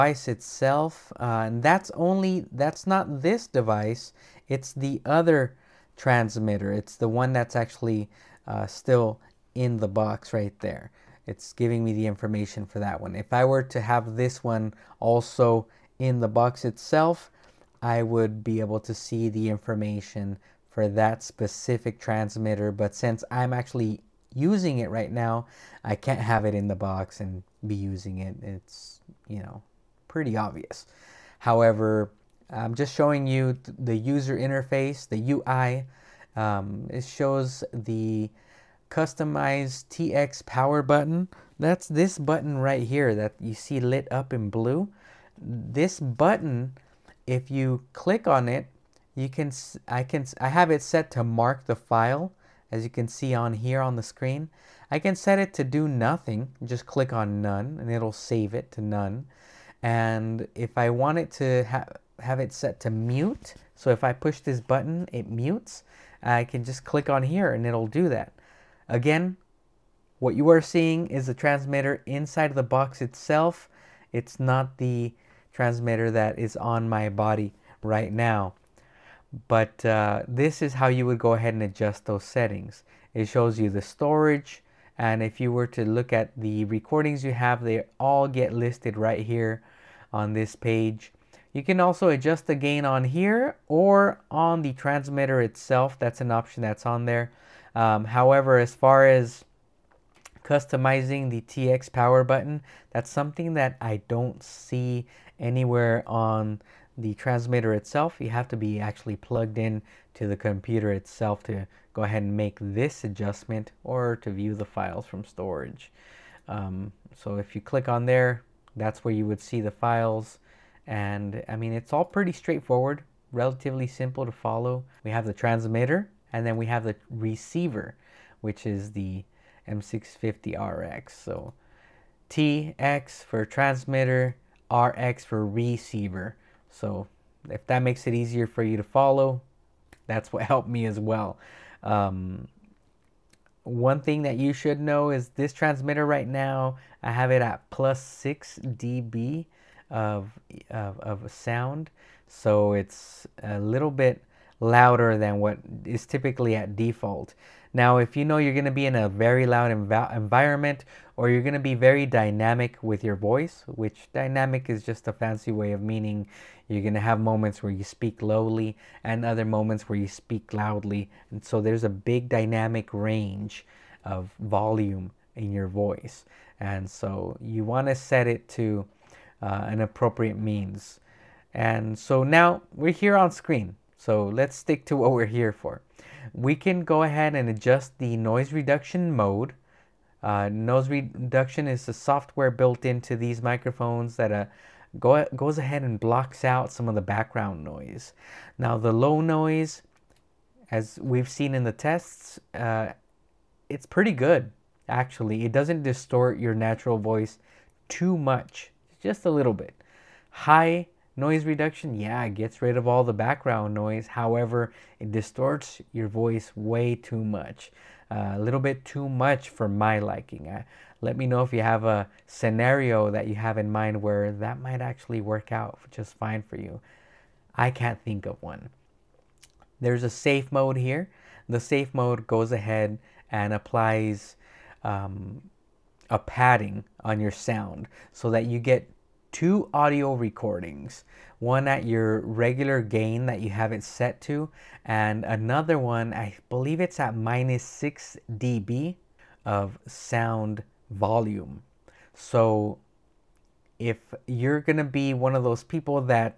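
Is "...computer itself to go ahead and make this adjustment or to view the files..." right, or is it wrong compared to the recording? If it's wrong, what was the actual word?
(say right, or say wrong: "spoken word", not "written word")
right.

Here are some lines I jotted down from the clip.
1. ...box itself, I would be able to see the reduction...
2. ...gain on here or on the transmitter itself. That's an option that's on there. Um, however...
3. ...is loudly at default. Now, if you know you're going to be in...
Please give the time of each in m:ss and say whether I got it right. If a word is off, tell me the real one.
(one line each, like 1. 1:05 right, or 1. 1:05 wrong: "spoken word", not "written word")
1. 0:16 wrong: "information", not "reduction"
2. 1:32 right
3. 2:35 wrong: "typically", not "loudly".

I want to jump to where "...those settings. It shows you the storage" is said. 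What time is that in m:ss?
1:22.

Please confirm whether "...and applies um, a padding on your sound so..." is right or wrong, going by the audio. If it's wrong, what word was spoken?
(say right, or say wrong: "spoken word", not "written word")
right.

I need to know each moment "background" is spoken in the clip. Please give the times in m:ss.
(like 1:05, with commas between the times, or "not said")
3:17, 3:33.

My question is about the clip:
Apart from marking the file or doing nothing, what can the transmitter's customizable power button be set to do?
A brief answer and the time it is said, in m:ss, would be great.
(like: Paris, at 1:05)
Mute, at 1:02.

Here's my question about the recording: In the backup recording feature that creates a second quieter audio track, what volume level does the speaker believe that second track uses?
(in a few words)
-6 dB.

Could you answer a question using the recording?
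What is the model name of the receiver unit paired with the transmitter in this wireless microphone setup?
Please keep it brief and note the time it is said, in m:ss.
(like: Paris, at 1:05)
M650RX, at 2:09.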